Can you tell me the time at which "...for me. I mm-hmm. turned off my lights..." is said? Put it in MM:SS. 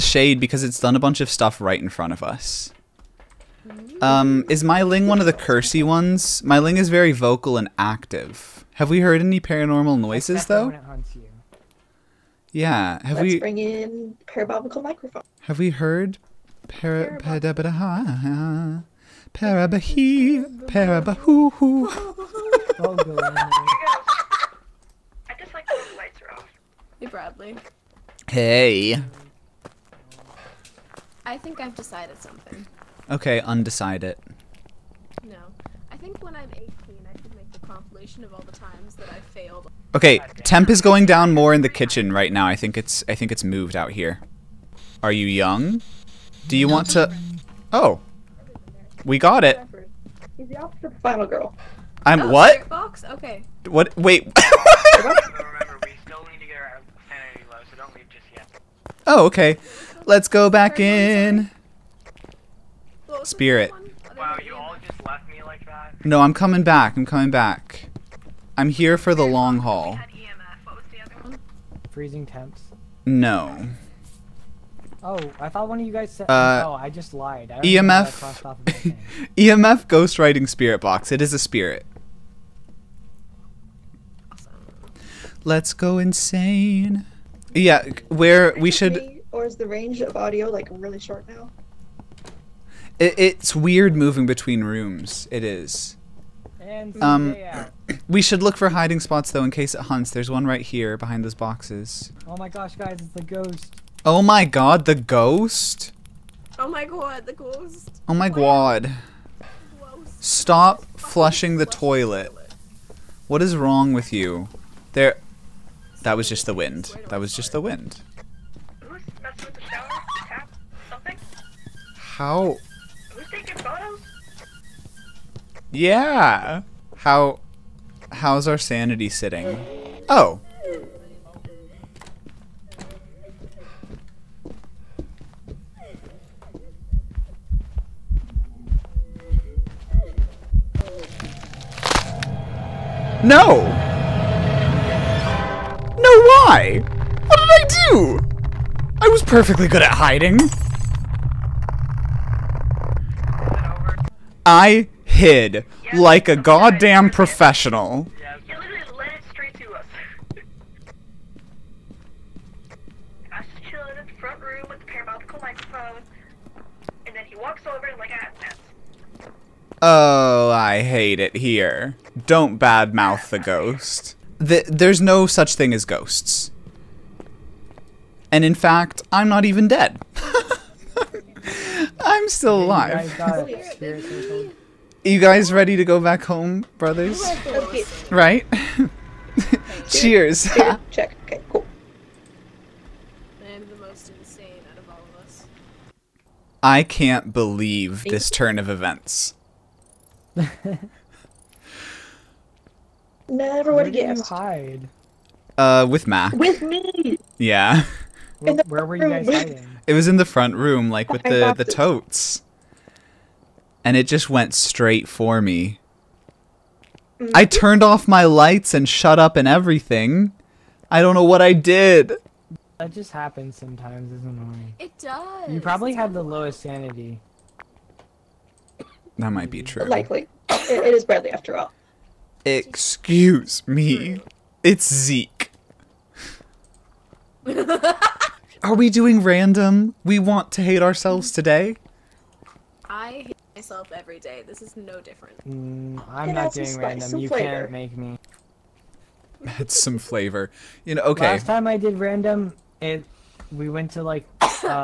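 03:35.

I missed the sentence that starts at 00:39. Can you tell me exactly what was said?
Okay, temp is going down more in the kitchen right now.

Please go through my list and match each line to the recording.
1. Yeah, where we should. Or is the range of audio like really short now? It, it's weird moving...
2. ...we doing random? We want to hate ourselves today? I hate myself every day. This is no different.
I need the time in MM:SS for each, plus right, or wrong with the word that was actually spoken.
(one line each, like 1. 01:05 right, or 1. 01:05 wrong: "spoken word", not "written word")
1. 01:27 right
2. 03:58 right.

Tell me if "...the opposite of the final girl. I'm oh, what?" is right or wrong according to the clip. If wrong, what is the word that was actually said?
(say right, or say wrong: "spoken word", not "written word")
right.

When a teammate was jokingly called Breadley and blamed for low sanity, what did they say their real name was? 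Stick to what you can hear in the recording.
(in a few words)
Zeke.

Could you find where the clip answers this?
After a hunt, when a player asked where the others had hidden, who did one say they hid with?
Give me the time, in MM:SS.
03:26.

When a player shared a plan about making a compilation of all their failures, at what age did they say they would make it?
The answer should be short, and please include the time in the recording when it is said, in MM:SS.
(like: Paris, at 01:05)
18, at 00:36.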